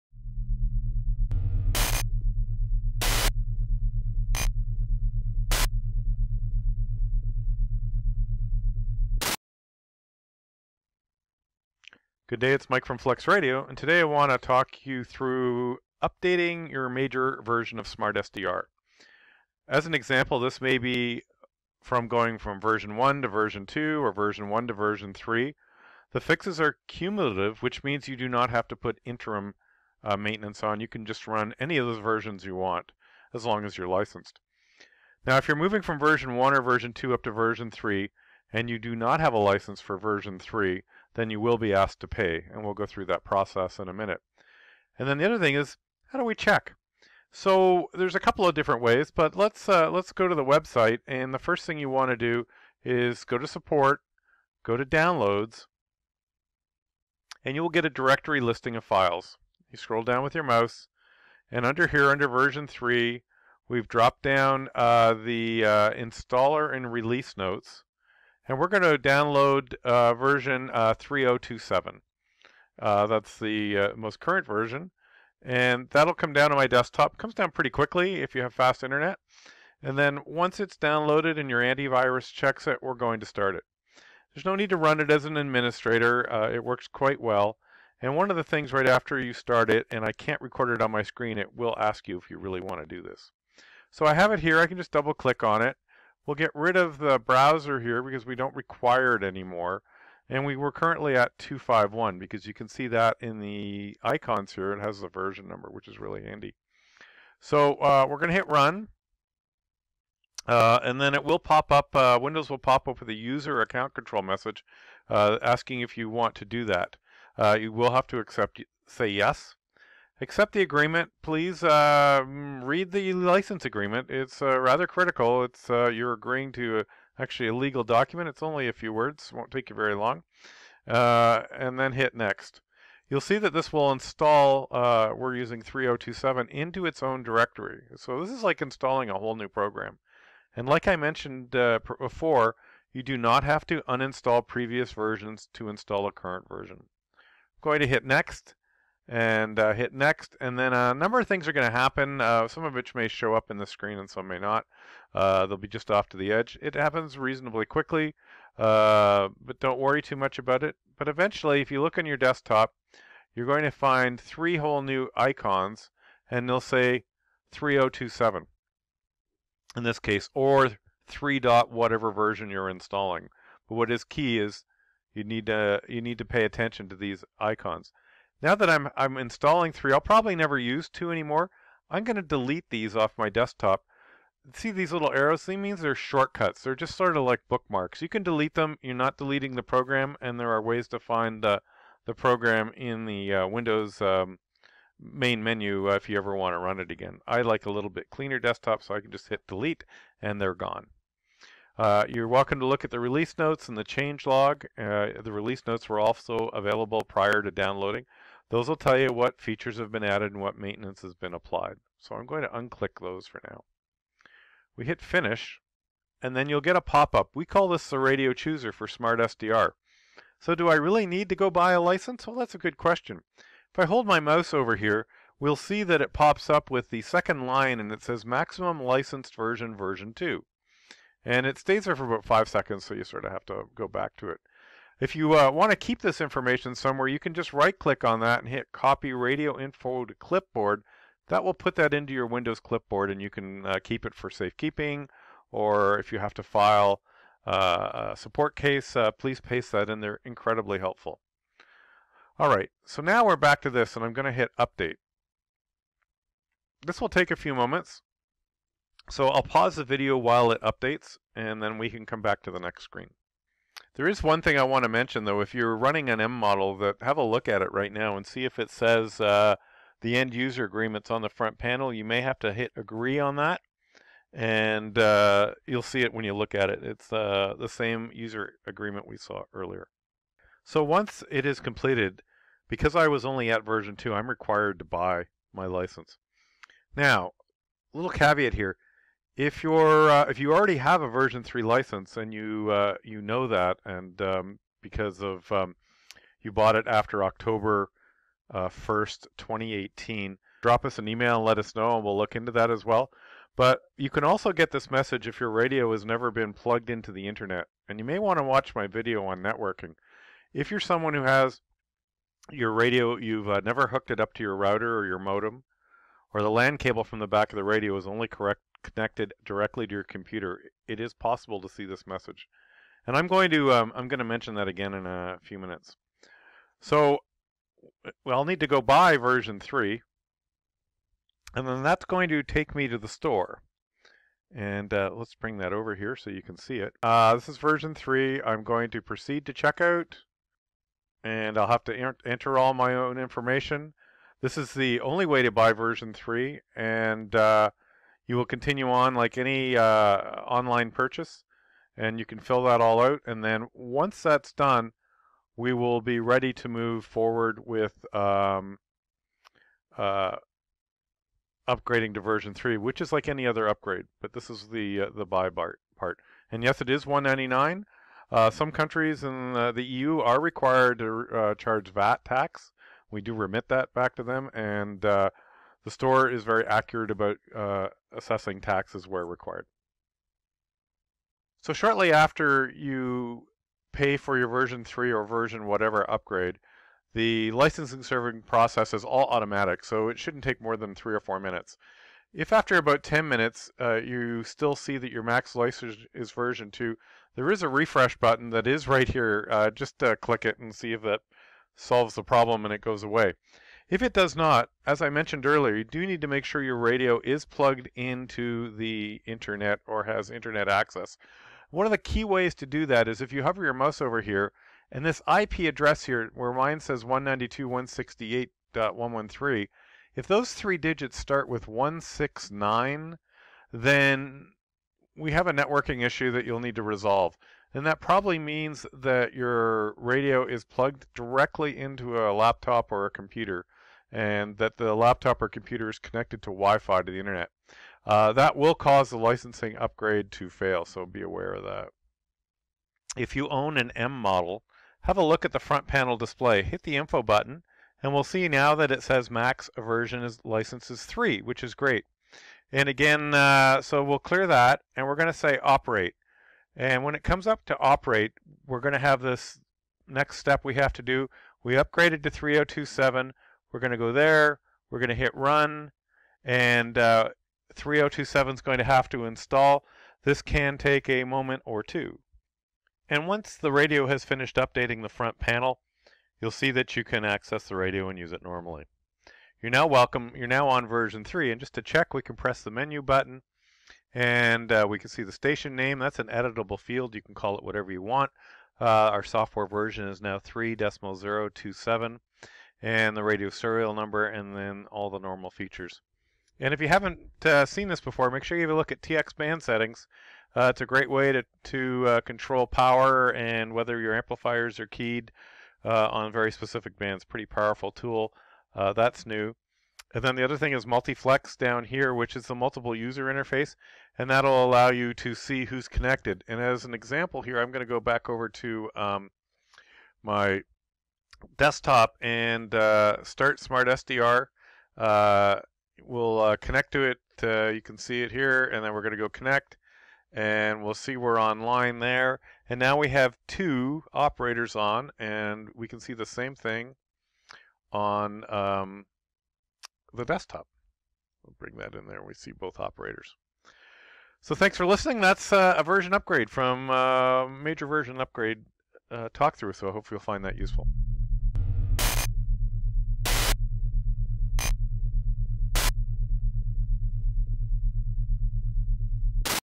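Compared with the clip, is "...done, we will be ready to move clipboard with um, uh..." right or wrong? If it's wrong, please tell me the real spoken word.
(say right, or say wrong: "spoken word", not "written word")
wrong: "forward", not "clipboard".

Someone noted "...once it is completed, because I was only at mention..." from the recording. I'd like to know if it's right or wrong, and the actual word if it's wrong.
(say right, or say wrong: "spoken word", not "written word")
wrong: "version", not "mention".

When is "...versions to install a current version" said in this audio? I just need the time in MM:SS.
02:24.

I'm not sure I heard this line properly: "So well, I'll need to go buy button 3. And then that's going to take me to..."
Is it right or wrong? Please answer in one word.
wrong.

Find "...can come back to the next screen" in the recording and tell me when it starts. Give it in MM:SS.
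04:21.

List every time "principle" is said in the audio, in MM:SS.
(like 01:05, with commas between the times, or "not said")
not said.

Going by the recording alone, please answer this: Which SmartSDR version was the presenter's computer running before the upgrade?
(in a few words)
251.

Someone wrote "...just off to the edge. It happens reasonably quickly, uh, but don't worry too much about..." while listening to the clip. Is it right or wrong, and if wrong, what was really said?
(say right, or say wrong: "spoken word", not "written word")
right.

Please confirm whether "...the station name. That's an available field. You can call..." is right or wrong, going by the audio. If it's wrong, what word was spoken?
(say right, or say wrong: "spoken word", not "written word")
wrong: "editable", not "available".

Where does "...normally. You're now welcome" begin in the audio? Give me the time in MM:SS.
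07:58.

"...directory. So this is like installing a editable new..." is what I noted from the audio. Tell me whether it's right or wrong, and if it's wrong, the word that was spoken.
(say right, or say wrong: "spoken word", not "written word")
wrong: "whole", not "editable".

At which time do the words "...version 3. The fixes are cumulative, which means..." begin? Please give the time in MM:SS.
00:24.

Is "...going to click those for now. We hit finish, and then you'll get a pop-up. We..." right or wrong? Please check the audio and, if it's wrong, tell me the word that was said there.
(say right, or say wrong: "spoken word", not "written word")
wrong: "unclick", not "click".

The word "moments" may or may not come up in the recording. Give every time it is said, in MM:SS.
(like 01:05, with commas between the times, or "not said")
04:17, 07:51.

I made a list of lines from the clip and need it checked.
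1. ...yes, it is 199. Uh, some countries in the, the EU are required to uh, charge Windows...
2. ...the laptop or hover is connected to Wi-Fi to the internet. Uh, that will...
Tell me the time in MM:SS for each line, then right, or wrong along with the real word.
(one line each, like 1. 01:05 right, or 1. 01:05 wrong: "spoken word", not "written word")
1. 06:06 wrong: "VAT", not "Windows"
2. 07:14 wrong: "computer", not "hover".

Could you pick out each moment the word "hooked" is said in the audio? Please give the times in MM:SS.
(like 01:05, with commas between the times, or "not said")
05:13.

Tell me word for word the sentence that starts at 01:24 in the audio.
There's no need to run it as an administrator.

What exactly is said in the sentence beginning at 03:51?
And it stays there for about five seconds, so you sort of have to go back to it.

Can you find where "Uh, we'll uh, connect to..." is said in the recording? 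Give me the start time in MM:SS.
08:44.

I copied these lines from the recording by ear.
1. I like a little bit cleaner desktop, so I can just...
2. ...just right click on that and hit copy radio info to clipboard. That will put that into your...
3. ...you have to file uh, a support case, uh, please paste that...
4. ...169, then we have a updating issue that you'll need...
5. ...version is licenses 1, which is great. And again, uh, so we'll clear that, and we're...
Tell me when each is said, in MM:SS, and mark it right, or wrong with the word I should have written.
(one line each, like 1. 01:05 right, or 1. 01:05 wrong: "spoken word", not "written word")
1. 03:17 right
2. 03:57 right
3. 04:06 right
4. 07:01 wrong: "networking", not "updating"
5. 07:29 wrong: "3", not "1".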